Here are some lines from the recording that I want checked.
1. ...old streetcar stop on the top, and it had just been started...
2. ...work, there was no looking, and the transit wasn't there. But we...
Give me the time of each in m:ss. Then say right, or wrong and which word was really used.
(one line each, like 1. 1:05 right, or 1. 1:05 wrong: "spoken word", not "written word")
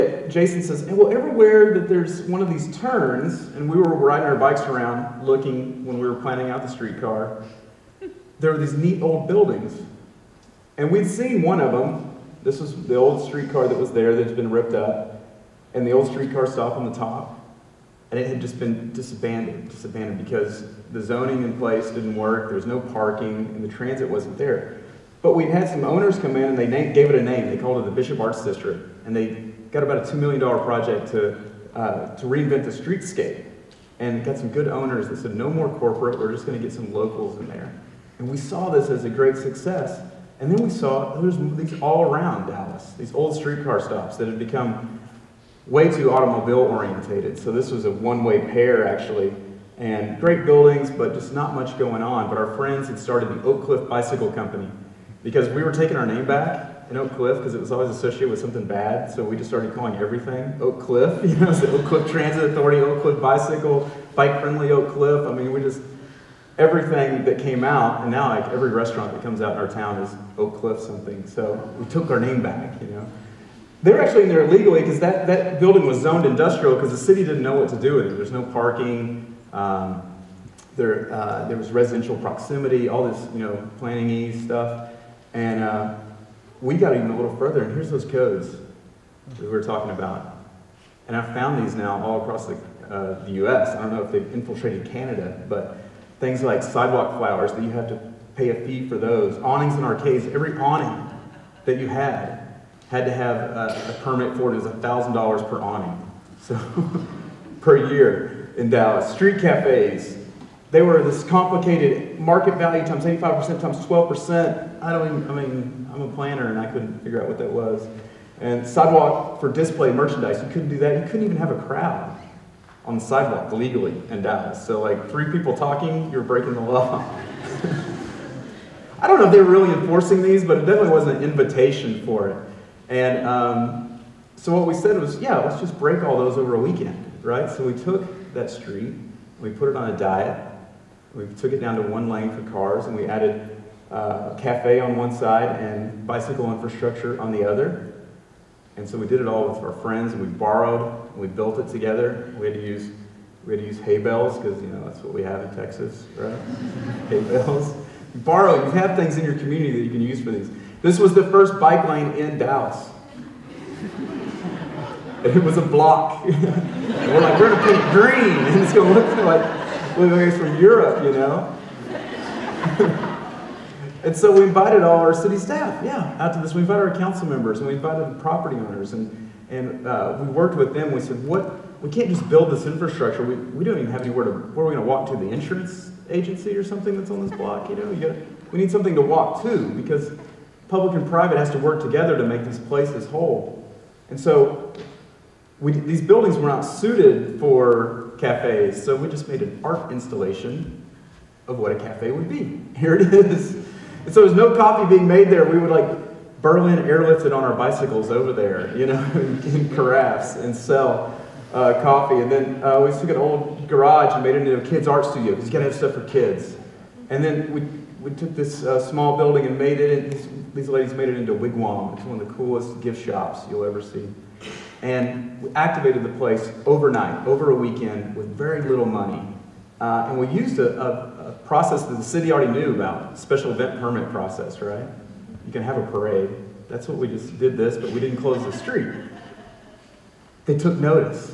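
1. 0:15 wrong: "disbanded", not "started"
2. 0:22 wrong: "parking", not "looking".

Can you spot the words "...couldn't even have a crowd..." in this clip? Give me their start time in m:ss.
2:01.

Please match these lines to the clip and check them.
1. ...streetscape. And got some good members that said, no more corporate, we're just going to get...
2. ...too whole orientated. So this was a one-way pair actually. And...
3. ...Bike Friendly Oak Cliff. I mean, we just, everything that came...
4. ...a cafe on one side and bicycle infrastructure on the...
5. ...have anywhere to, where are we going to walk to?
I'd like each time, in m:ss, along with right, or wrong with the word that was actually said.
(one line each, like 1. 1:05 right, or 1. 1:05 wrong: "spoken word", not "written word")
1. 0:32 wrong: "owners", not "members"
2. 0:45 wrong: "automobile", not "whole"
3. 1:04 right
4. 2:24 right
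5. 3:03 right.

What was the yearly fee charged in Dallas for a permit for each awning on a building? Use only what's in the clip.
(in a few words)
$1,000.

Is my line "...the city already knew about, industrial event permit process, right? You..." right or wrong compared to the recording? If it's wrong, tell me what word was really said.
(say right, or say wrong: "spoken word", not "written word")
wrong: "special", not "industrial".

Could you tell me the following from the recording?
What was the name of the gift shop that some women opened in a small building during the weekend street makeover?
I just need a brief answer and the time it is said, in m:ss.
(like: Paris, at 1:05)
Wigwam, at 3:41.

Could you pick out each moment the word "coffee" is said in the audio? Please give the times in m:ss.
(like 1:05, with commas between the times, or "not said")
3:24, 3:31.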